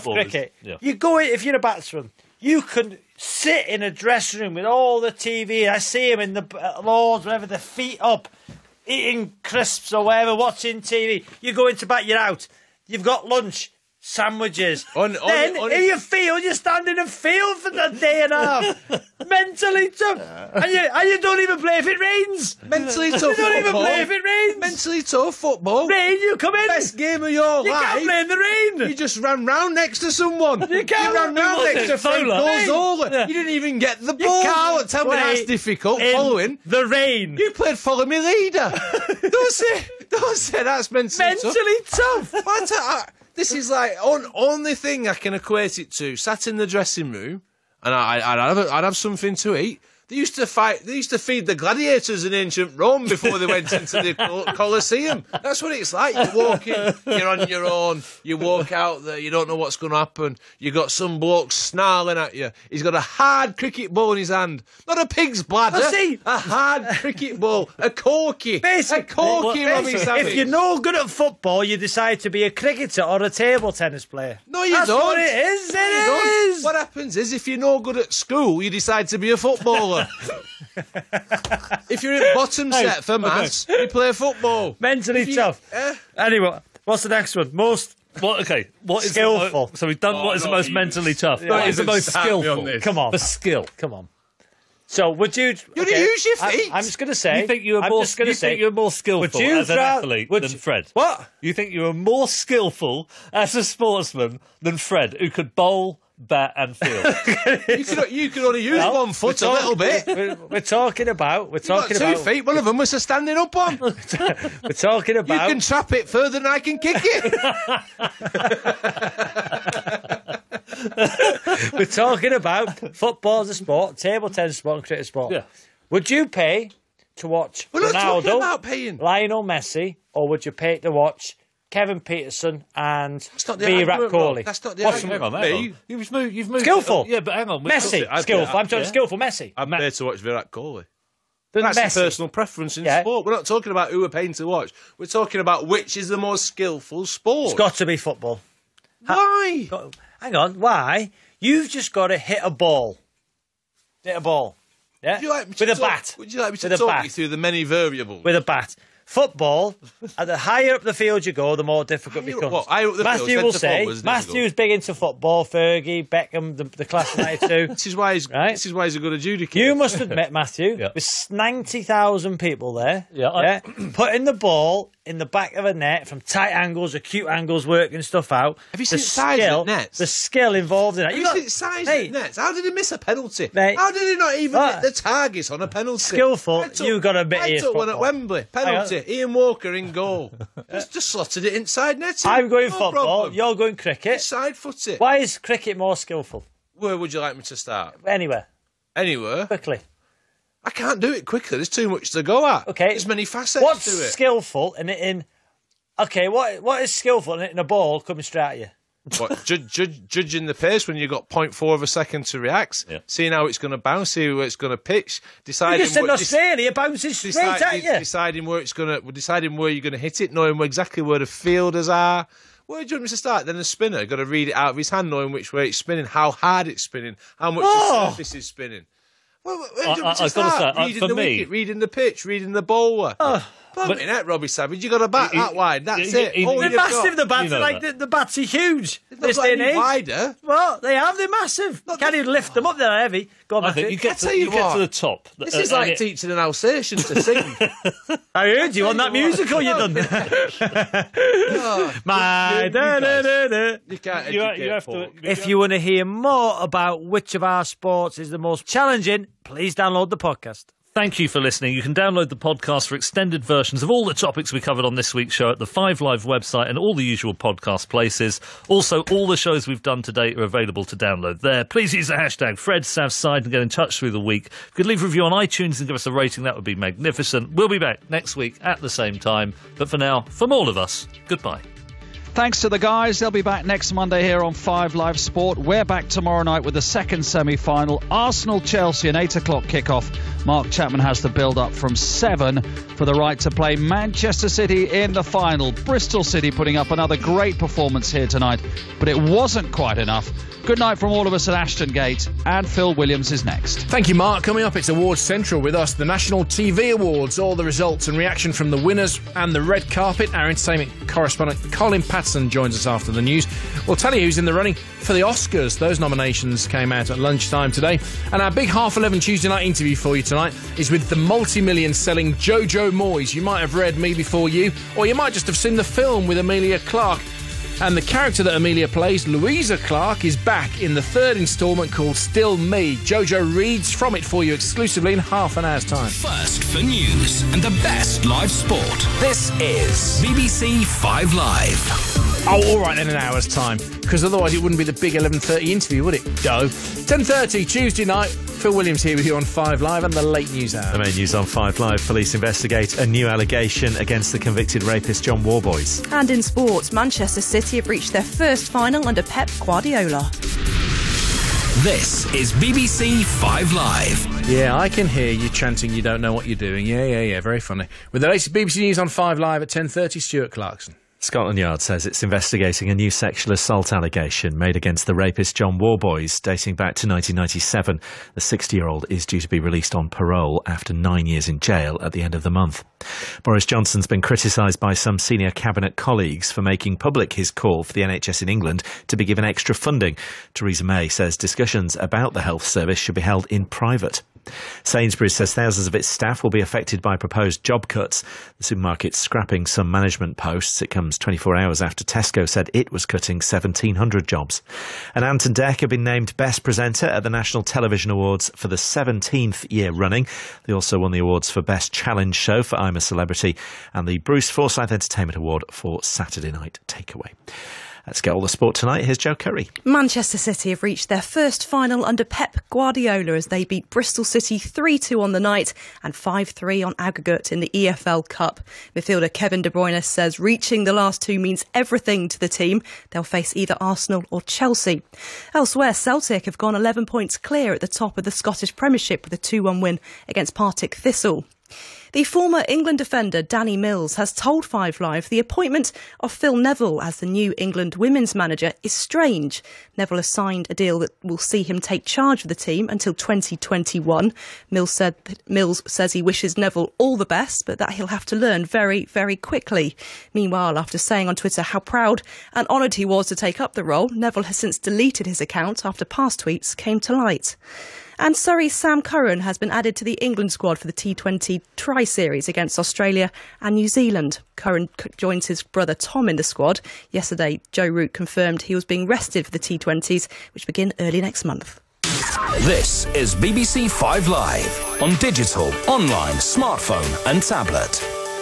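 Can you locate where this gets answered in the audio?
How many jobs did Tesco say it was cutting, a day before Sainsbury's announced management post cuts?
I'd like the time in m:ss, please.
6:43.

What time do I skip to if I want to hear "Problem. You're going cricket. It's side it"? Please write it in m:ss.
3:12.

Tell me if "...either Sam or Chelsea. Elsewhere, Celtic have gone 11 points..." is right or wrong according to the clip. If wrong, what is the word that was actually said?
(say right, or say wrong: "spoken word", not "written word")
wrong: "Arsenal", not "Sam".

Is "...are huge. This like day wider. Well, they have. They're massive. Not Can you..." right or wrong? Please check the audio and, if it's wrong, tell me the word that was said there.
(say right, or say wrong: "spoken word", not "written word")
right.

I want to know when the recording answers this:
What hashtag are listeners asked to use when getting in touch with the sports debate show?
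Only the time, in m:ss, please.
4:32.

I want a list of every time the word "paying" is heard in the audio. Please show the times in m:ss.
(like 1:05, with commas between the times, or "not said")
2:08, 2:24.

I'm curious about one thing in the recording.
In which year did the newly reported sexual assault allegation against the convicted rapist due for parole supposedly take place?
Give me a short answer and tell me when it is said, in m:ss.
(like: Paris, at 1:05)
1997, at 6:17.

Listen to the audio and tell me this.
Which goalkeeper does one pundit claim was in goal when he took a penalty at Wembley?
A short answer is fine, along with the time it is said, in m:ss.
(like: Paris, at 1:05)
Ian Walker, at 3:09.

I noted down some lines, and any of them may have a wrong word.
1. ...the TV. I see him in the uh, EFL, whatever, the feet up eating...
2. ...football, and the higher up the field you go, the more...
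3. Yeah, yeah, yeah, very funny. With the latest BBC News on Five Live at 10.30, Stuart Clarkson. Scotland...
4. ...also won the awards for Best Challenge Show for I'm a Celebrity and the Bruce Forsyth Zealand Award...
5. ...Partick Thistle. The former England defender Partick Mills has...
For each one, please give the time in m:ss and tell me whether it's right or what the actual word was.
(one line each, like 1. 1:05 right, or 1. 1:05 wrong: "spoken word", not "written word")
1. 0:04 wrong: "Lords", not "EFL"
2. 2:39 right
3. 6:06 right
4. 6:50 wrong: "Entertainment", not "Zealand"
5. 7:20 wrong: "Danny", not "Partick".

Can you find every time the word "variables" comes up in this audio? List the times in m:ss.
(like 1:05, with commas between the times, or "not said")
2:37.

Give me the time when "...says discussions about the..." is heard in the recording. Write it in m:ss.
6:31.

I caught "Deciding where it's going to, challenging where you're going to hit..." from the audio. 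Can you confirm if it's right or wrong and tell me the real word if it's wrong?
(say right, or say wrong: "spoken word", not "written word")
wrong: "deciding", not "challenging".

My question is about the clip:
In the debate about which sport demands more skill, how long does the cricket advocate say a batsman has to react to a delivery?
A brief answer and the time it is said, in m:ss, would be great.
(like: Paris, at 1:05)
0.4 of a second, at 3:31.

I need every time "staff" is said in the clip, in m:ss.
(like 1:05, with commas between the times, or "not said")
6:36.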